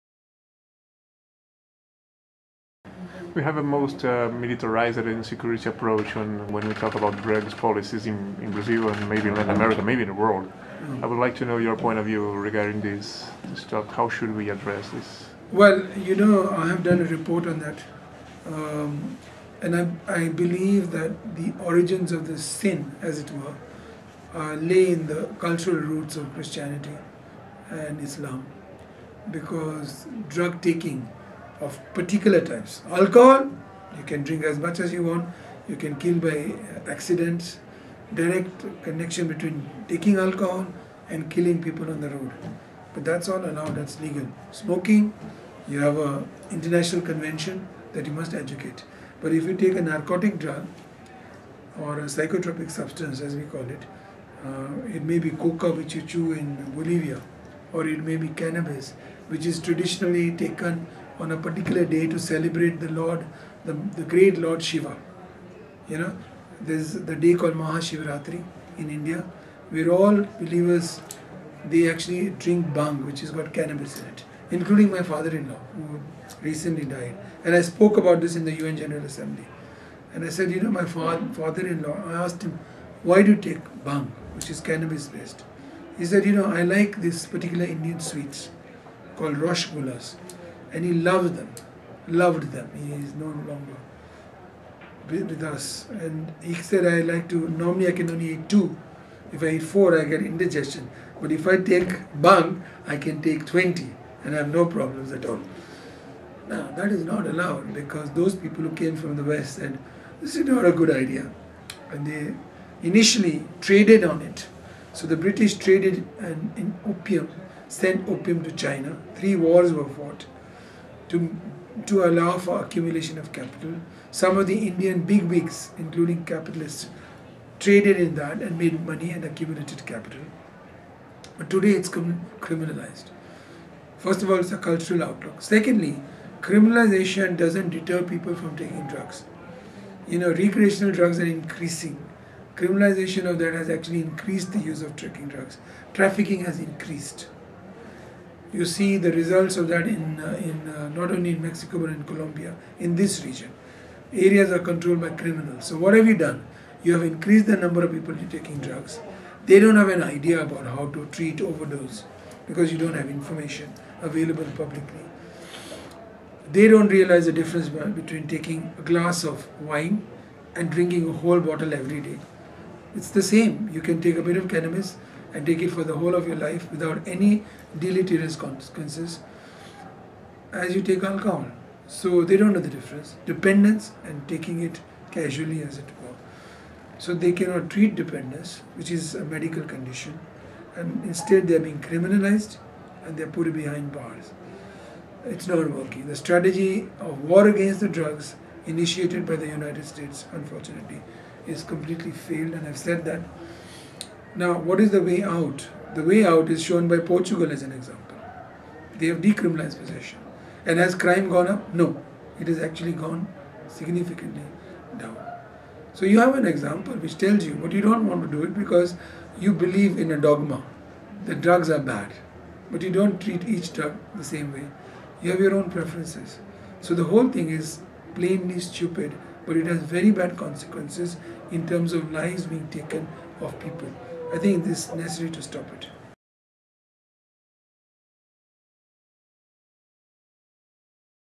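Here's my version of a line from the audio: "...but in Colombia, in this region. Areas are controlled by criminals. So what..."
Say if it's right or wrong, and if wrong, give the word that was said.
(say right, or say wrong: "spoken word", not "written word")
right.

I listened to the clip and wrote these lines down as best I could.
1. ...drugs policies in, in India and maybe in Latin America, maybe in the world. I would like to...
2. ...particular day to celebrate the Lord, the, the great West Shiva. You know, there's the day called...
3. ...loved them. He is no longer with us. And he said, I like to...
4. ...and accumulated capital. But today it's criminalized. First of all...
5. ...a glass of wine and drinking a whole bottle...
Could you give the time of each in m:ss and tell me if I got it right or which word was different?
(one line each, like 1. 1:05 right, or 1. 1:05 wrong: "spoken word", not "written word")
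1. 0:07 wrong: "Brazil", not "India"
2. 1:01 wrong: "Lord", not "West"
3. 1:32 right
4. 2:09 right
5. 2:48 right.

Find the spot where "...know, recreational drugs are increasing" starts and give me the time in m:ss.
2:20.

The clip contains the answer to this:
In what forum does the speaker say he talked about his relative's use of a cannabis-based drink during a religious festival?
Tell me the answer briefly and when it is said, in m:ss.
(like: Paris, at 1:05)
UN General Assembly, at 1:18.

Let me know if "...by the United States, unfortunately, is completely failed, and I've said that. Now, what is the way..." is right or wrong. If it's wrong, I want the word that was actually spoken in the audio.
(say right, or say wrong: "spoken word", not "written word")
right.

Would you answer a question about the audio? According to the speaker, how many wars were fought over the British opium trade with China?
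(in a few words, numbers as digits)
3.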